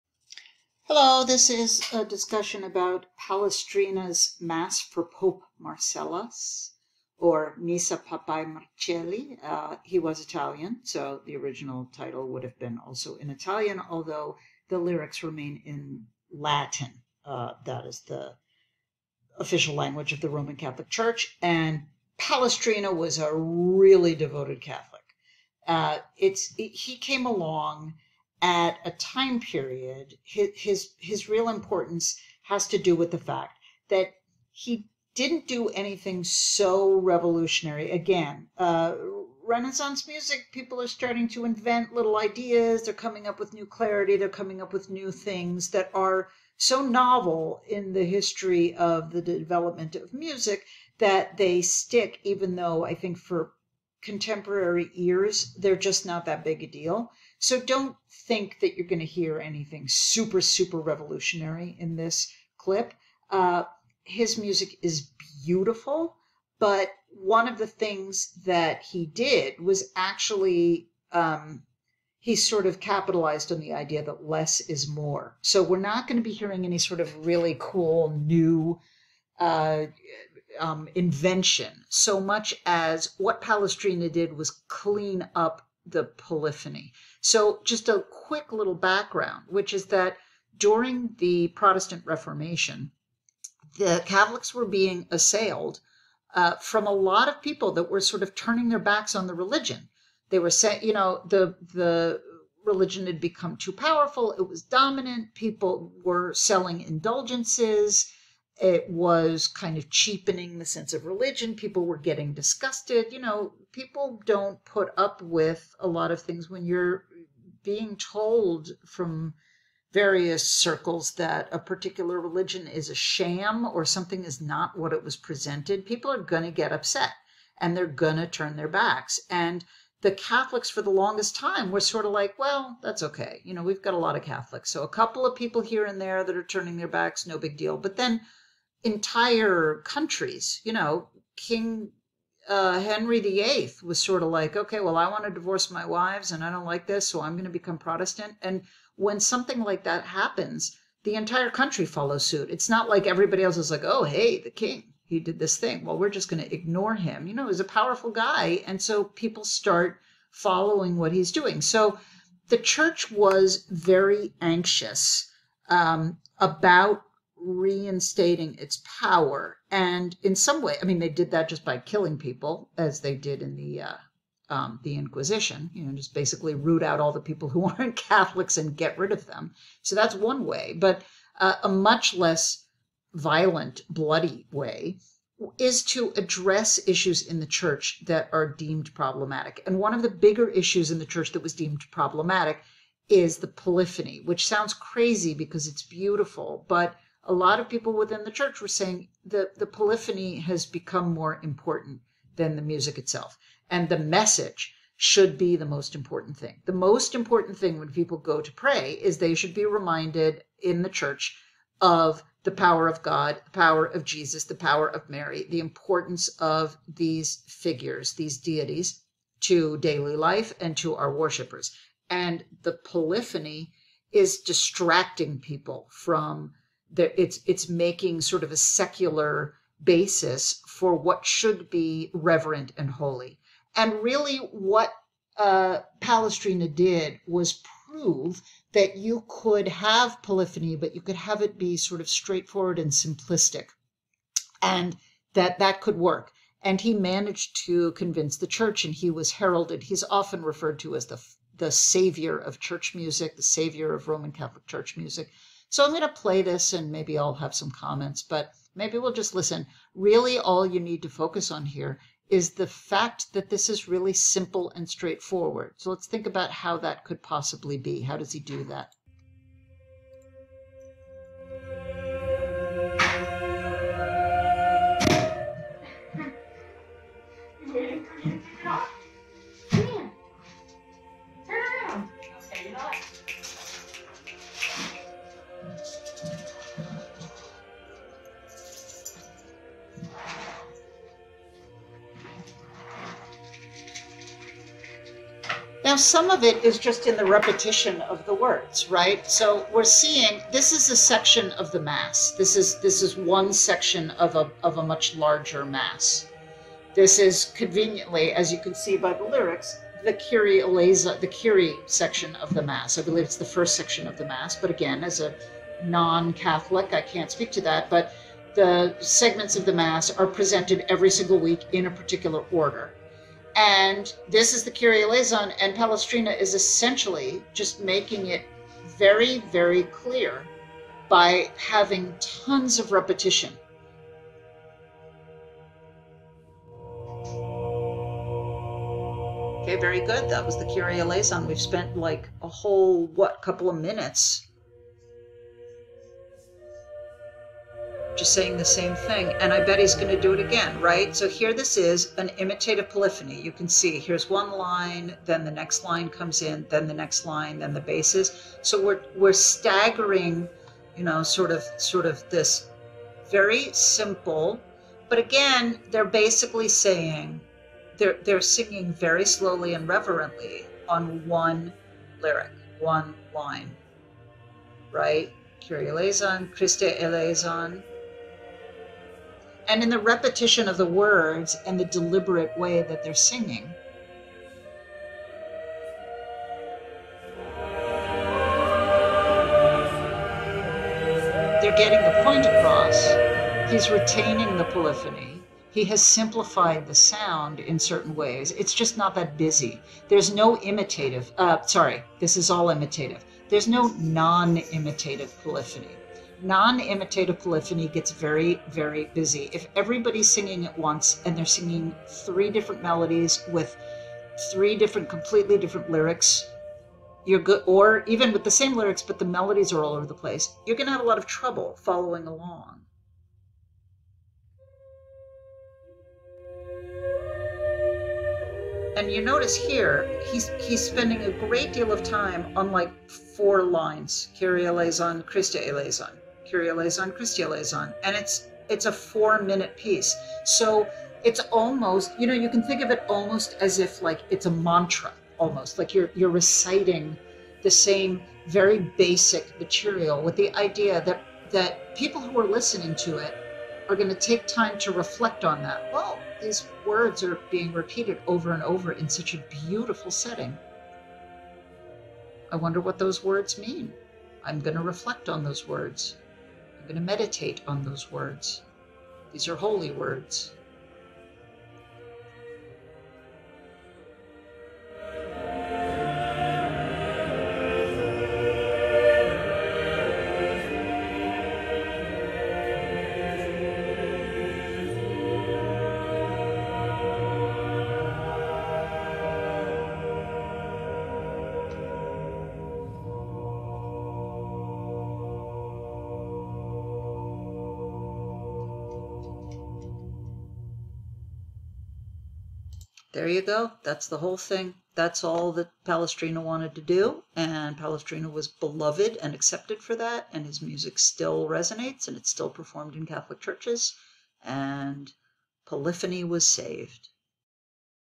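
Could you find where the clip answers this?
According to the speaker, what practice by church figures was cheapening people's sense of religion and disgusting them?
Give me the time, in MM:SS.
01:46.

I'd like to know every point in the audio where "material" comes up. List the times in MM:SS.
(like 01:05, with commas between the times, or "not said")
07:29.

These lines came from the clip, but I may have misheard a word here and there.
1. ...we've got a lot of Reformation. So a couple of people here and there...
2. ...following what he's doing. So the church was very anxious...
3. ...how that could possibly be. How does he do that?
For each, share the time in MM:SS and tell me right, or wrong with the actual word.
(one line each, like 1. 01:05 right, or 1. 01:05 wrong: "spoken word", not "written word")
1. 02:13 wrong: "Catholics", not "Reformation"
2. 02:40 right
3. 04:26 right.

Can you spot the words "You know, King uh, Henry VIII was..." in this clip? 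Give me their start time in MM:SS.
02:20.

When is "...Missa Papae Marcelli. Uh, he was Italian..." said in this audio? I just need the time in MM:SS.
00:07.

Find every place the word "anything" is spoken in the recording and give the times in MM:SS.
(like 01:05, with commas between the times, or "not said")
00:35, 00:59.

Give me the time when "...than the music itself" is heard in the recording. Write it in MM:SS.
03:22.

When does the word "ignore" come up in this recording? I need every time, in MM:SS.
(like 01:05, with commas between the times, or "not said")
02:36.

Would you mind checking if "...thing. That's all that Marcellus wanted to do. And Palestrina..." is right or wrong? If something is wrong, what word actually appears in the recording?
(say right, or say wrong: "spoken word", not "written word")
wrong: "Palestrina", not "Marcellus".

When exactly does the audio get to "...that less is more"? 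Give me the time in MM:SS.
01:14.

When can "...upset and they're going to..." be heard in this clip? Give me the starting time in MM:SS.
02:06.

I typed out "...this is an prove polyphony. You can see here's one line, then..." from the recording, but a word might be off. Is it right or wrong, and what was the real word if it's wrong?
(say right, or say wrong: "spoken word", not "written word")
wrong: "imitative", not "prove".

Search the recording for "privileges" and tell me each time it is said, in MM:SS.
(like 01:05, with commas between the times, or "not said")
not said.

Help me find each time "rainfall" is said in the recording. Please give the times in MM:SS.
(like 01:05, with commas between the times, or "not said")
not said.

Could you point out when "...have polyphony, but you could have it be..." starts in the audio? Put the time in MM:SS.
03:59.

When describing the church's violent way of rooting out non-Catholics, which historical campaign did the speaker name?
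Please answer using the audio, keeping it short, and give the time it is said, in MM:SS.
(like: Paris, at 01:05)
The Inquisition, at 02:54.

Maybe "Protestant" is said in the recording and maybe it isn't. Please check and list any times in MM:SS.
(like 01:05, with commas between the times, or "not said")
01:31, 02:27.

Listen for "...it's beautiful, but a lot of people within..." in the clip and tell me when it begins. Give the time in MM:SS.
03:15.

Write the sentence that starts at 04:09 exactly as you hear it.
He's often referred to as the the savior of church music, the savior of Roman Catholic church music.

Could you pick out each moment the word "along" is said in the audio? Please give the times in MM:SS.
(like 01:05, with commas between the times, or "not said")
00:27, 07:02.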